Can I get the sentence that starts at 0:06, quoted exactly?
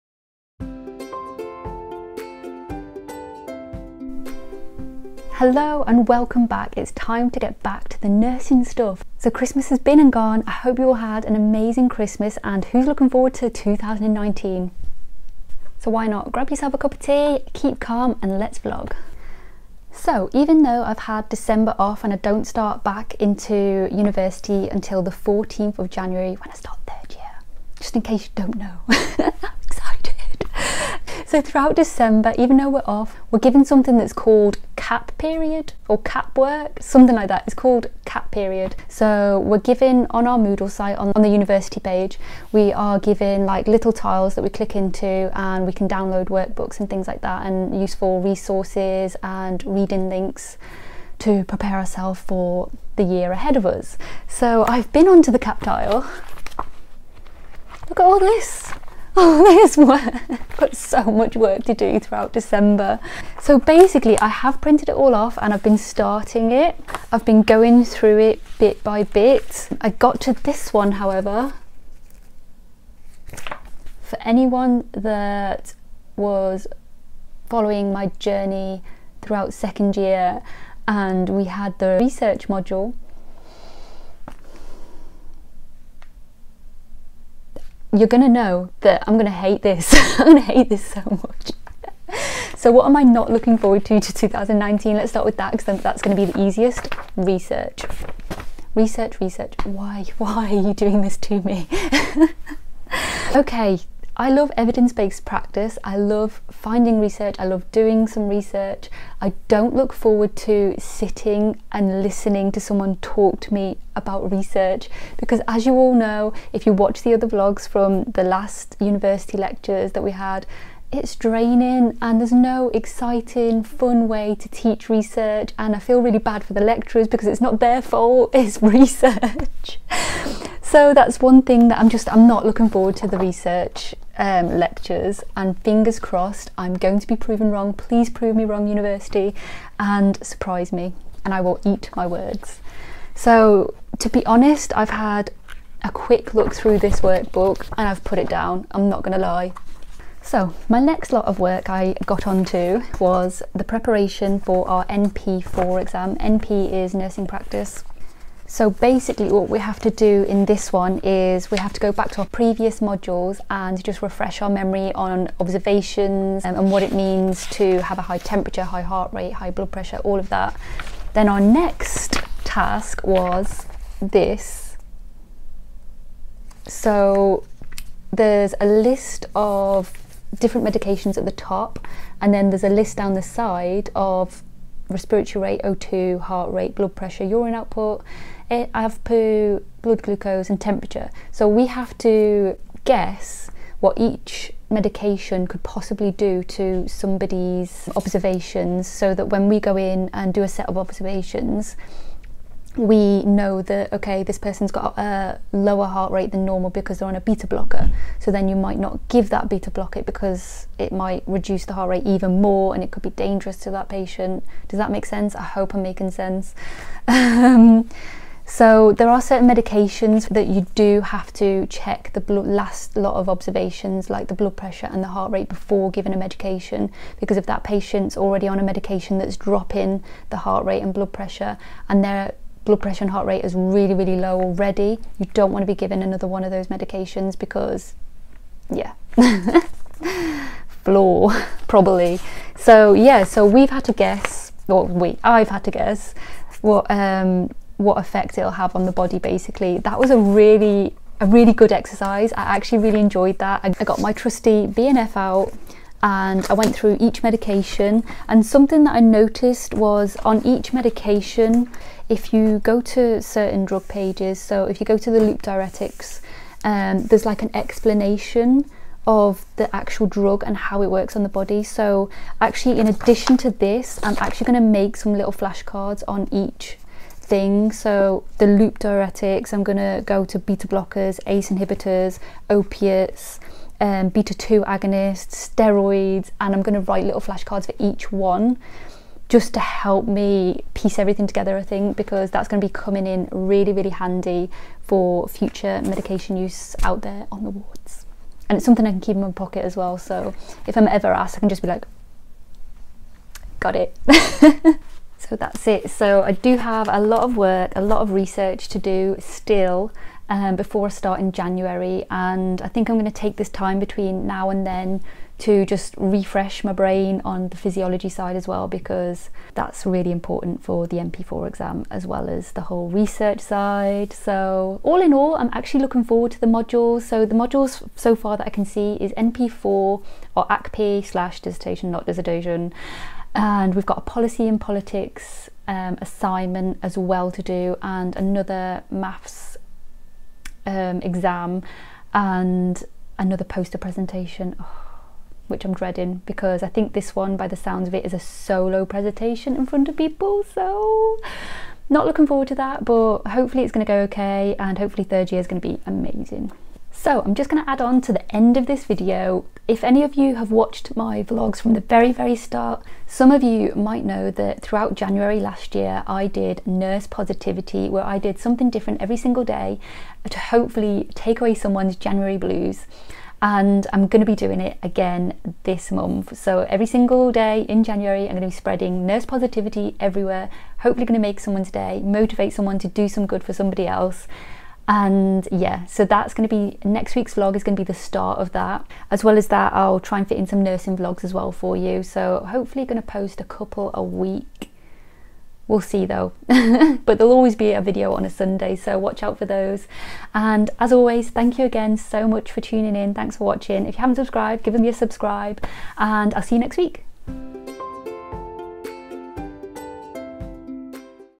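It's time to get back to the nursing stuff.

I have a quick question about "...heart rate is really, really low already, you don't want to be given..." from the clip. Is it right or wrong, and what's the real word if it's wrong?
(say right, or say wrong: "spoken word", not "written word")
right.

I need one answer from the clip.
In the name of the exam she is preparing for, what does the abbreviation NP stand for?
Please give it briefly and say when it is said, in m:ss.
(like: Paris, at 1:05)
nursing practice, at 2:36.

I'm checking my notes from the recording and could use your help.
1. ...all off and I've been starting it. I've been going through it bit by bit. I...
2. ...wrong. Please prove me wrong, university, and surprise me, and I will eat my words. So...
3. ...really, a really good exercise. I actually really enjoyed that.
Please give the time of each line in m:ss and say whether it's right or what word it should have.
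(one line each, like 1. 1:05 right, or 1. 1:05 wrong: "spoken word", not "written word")
1. 1:04 right
2. 2:17 right
3. 4:10 right.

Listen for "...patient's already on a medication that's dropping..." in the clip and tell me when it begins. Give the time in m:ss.
3:47.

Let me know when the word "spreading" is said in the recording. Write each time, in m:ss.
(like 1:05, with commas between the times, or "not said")
6:18.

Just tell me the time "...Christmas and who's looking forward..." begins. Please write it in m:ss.
0:11.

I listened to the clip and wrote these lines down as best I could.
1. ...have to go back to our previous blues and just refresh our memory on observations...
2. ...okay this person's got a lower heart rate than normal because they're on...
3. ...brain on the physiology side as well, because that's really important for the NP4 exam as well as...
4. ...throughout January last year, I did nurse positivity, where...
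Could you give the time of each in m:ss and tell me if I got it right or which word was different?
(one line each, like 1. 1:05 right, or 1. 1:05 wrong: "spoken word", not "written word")
1. 2:41 wrong: "modules", not "blues"
2. 3:23 right
3. 5:16 right
4. 6:04 right.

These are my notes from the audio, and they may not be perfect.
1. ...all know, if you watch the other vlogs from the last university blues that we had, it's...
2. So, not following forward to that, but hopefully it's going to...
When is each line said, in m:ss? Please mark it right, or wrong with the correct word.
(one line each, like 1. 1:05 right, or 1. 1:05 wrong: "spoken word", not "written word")
1. 1:55 wrong: "lectures", not "blues"
2. 5:50 wrong: "looking", not "following".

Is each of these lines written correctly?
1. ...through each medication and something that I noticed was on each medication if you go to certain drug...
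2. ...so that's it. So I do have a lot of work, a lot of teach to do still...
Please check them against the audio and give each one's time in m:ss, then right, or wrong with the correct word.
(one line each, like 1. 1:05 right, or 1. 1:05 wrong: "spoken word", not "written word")
1. 4:16 right
2. 5:05 wrong: "research", not "teach".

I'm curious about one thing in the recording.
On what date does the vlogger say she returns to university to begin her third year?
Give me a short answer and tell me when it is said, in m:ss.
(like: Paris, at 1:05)
14th of January, at 0:25.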